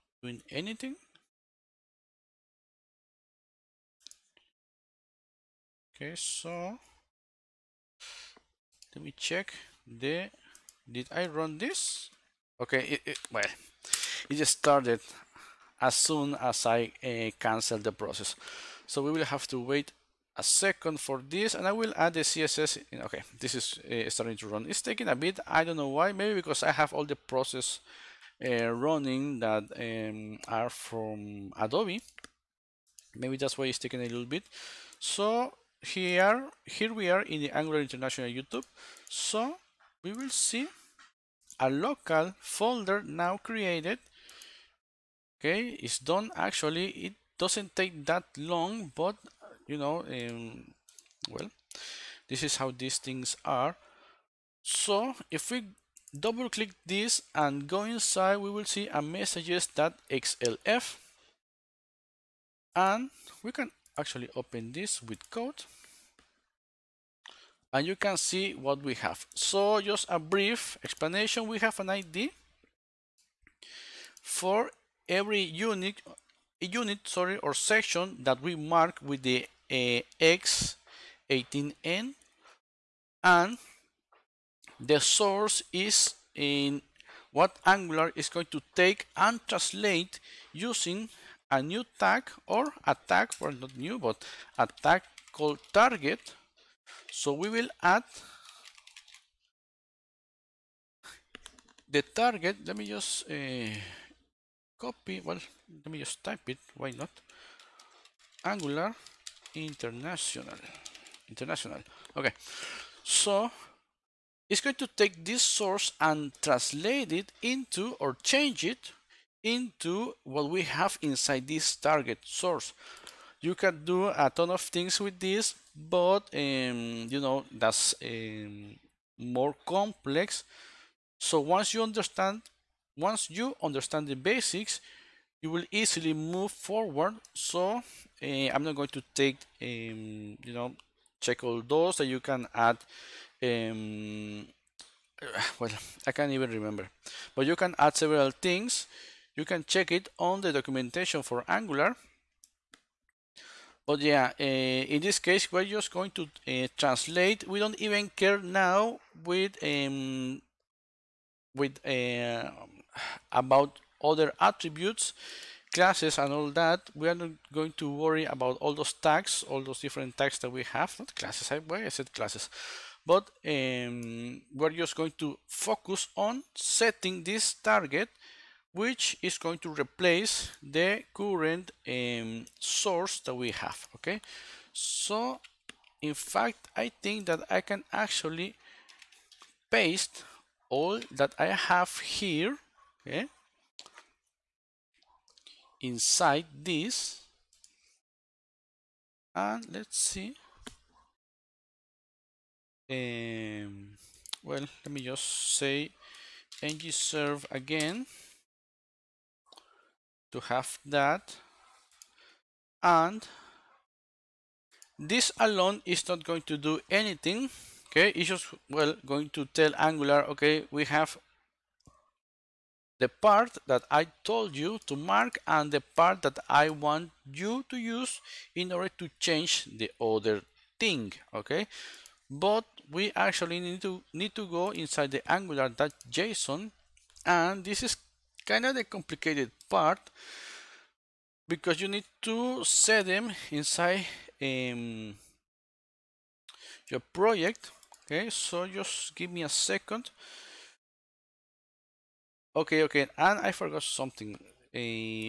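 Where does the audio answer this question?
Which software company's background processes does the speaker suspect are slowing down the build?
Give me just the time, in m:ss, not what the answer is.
0:31.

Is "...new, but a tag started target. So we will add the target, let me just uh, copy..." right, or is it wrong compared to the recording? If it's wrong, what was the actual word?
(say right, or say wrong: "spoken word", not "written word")
wrong: "called", not "started".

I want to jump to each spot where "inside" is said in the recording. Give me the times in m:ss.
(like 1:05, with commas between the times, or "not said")
0:57, 2:01, 3:15, 3:54, 4:03.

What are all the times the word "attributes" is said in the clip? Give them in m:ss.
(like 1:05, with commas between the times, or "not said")
2:44.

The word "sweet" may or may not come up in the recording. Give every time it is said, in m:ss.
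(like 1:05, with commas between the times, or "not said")
not said.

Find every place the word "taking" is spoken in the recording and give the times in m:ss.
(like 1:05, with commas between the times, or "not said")
0:24, 0:33.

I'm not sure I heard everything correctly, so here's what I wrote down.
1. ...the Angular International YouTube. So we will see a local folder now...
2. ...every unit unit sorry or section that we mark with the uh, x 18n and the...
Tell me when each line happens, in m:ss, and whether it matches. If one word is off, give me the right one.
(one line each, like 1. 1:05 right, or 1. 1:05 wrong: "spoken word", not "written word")
1. 0:37 right
2. 1:15 right.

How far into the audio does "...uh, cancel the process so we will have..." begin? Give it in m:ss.
0:17.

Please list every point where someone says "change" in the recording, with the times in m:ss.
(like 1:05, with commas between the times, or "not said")
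1:58, 3:49.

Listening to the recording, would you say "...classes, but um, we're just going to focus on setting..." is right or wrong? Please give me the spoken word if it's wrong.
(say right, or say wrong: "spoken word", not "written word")
right.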